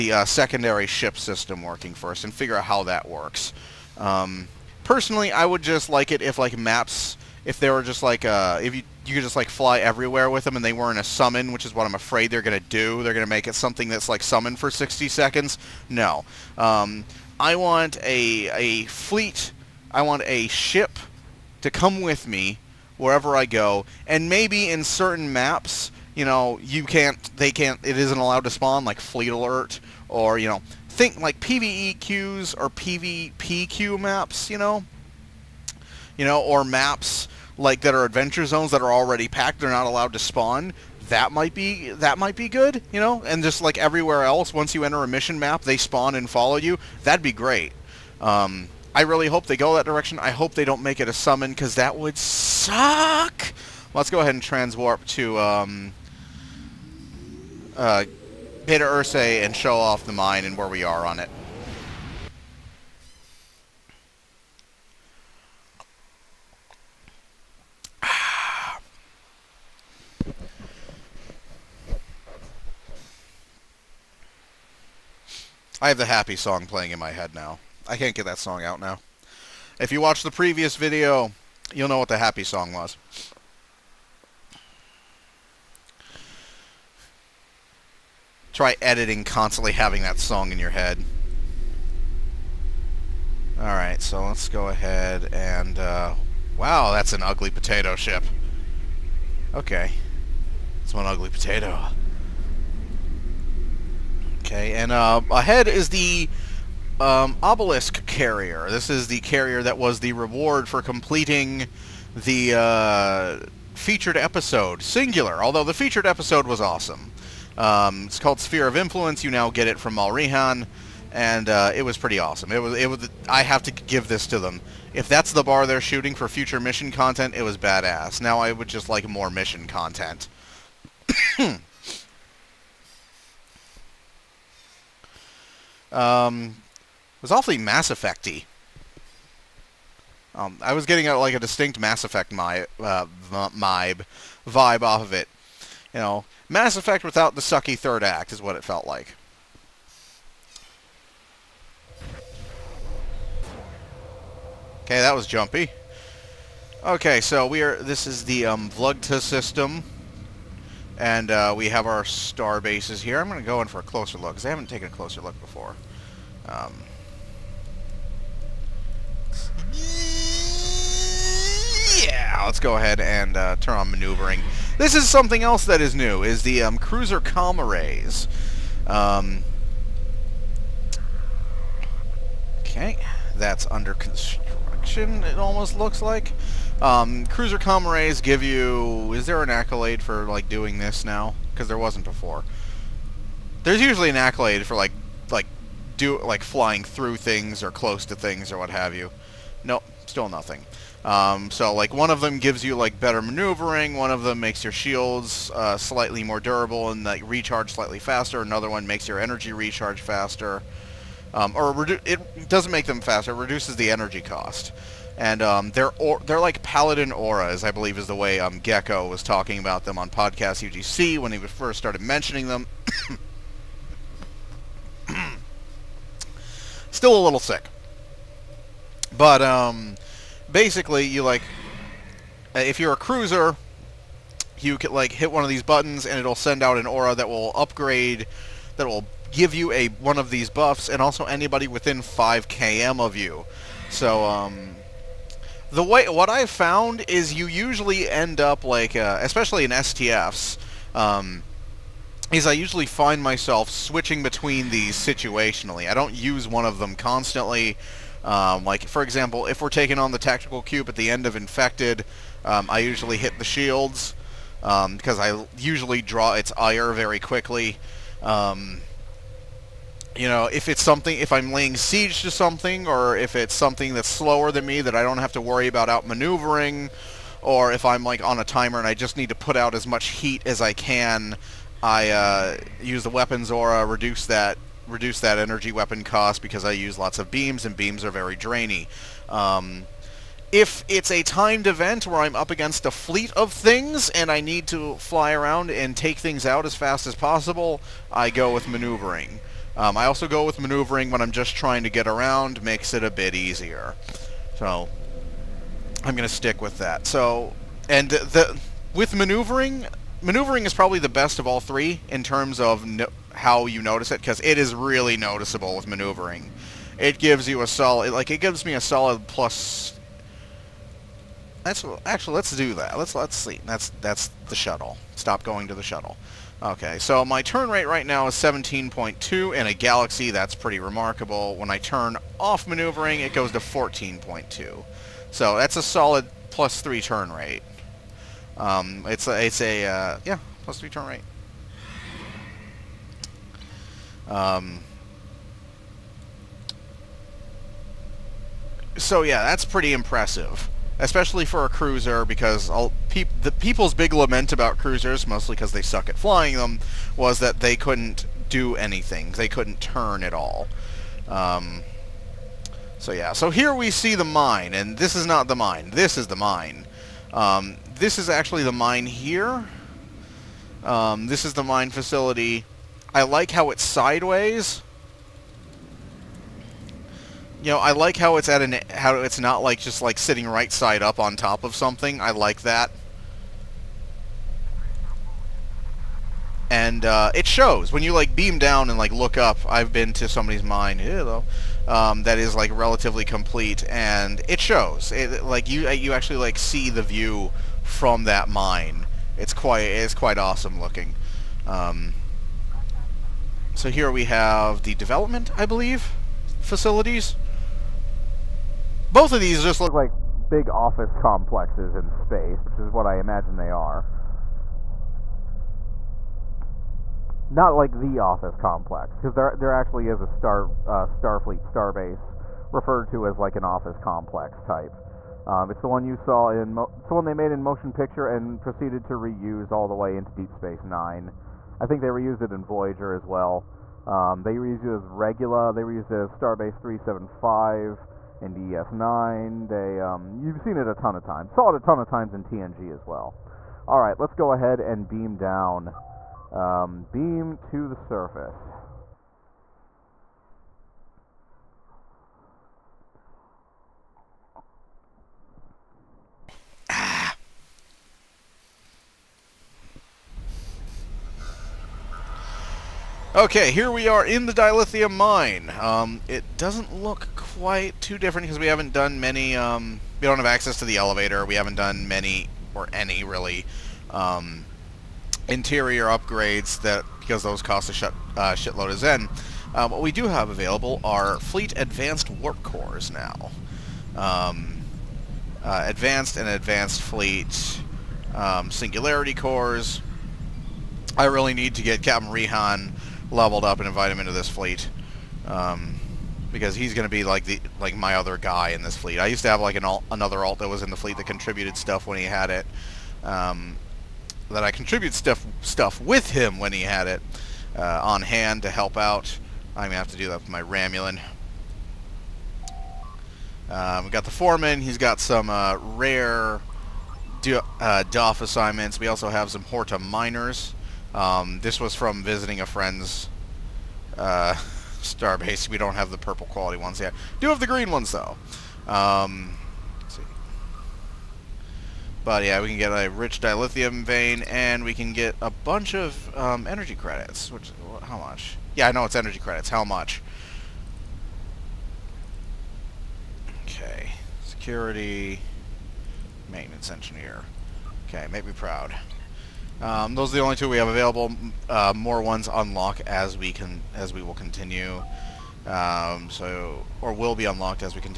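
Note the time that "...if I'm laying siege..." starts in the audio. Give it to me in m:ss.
4:31.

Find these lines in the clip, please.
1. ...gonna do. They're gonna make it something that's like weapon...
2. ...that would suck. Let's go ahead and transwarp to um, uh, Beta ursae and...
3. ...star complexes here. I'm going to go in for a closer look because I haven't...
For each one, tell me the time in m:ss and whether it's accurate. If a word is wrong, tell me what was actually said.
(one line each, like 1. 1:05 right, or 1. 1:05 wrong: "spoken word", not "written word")
1. 0:12 wrong: "summon", not "weapon"
2. 0:51 right
3. 2:42 wrong: "bases", not "complexes".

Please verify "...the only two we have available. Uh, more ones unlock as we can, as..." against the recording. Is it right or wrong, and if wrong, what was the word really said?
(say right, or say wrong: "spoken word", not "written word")
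right.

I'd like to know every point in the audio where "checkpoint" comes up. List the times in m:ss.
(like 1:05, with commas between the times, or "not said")
not said.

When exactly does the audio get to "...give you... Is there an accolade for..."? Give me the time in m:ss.
3:08.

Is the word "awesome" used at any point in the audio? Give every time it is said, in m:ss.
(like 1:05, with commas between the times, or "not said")
1:56, 2:02, 6:40.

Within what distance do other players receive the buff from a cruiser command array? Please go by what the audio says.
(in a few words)
5 km.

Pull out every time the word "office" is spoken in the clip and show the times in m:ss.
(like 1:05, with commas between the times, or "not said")
6:50, 6:58, 7:03.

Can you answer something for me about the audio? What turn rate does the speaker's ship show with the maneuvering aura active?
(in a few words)
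17.2.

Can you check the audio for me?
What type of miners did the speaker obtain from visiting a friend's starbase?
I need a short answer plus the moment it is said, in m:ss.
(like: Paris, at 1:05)
Horta miners, at 8:39.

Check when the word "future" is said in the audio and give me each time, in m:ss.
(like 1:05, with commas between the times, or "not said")
2:06.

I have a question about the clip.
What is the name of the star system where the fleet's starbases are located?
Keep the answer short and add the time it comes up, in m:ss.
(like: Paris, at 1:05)
Vlugta, at 2:38.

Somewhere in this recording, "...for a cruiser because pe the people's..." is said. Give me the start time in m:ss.
5:51.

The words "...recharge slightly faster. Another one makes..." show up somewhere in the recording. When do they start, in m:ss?
3:27.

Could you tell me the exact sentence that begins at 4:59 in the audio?
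Um, I also go with maneuvering when I'm just trying to get around, makes it a bit easier.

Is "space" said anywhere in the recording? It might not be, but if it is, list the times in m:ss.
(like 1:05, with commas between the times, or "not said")
6:52, 7:10.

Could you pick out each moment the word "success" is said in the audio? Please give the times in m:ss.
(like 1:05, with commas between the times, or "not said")
not said.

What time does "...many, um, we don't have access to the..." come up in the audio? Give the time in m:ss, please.
7:49.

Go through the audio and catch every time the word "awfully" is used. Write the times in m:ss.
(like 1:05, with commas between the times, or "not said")
2:17.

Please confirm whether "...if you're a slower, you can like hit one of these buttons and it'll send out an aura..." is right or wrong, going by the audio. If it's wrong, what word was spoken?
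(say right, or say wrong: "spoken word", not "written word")
wrong: "cruiser", not "slower".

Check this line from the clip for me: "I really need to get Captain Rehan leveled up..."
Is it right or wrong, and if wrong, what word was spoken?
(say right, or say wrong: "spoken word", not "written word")
right.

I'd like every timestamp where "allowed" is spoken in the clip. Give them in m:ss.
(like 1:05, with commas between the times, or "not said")
0:28, 0:39.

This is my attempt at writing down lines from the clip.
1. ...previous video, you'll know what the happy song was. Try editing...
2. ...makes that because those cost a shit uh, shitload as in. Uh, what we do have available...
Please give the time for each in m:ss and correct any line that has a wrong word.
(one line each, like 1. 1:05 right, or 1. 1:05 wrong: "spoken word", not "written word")
1. 1:20 right
2. 7:56 wrong: "upgrades", not "makes".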